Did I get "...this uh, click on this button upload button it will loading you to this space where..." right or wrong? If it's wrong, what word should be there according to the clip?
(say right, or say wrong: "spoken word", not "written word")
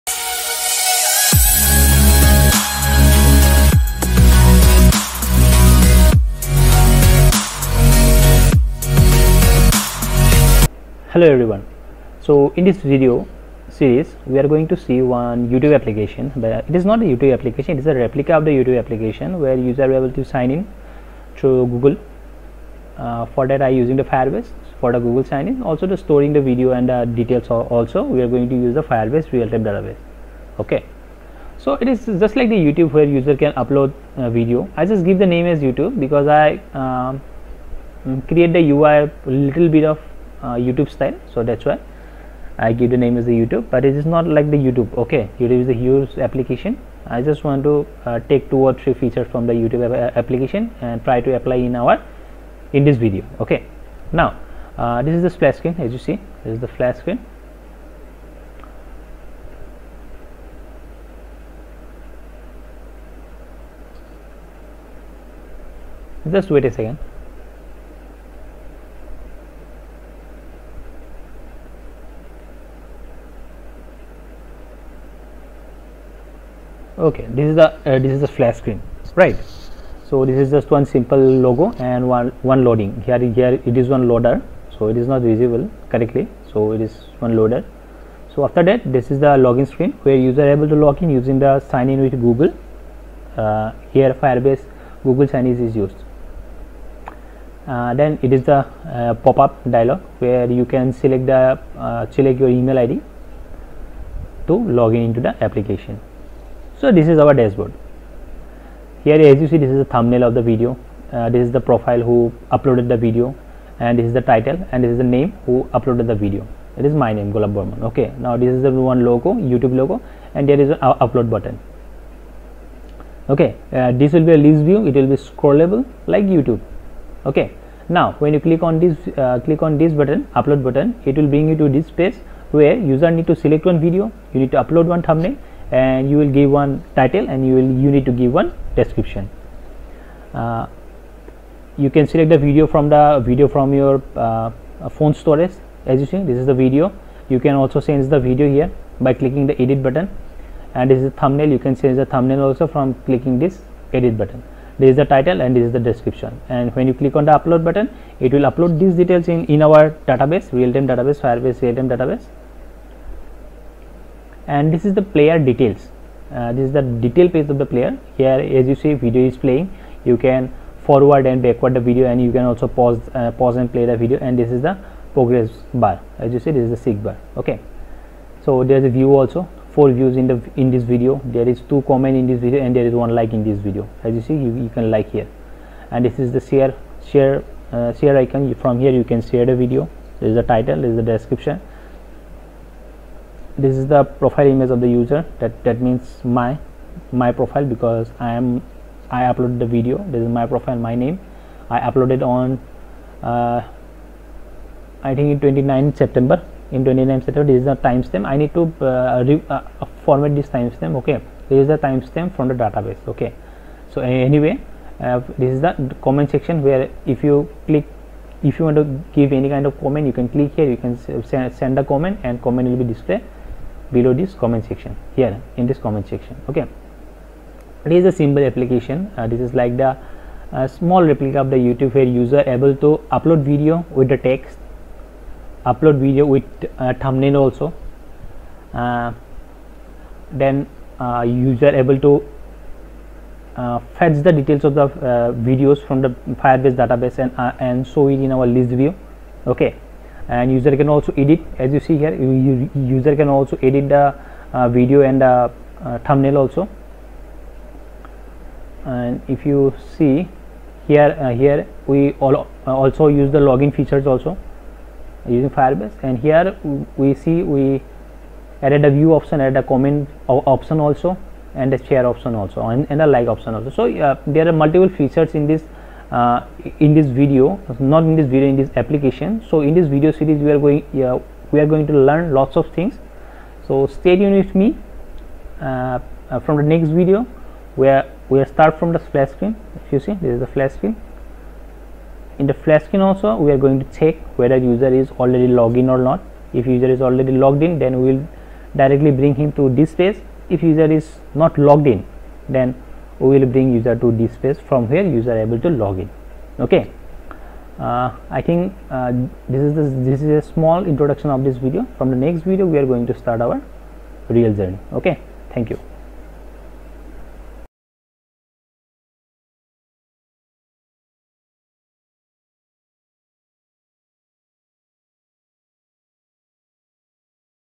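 wrong: "bring", not "loading".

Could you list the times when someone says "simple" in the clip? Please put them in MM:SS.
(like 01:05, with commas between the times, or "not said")
01:20, 03:48.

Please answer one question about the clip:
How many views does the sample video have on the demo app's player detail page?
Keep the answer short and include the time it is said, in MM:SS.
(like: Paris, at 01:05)
4, at 02:59.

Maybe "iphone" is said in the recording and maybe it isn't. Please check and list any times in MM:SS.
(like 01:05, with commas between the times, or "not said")
not said.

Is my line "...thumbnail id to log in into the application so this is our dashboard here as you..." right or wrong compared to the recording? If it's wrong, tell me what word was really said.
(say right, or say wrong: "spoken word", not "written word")
wrong: "email", not "thumbnail".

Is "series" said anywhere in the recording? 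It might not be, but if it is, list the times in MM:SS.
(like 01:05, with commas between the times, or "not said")
00:13, 04:40.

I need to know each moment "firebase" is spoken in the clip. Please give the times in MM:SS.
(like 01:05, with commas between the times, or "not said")
00:24, 00:28, 01:34, 02:41, 04:06, 04:25.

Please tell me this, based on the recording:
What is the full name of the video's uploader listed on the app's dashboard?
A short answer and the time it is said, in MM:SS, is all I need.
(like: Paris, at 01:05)
Golap Barman, at 01:57.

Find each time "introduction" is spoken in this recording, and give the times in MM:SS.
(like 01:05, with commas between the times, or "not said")
05:10.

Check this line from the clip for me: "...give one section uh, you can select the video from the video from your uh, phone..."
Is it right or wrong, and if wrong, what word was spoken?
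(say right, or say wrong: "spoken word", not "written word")
wrong: "description", not "section".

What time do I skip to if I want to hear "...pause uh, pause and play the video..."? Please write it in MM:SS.
02:52.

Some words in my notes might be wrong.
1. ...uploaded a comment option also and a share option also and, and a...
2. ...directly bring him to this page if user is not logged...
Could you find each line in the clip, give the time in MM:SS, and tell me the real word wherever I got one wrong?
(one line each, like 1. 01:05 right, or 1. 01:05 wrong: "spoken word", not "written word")
1. 04:29 wrong: "added", not "uploaded"
2. 04:58 right.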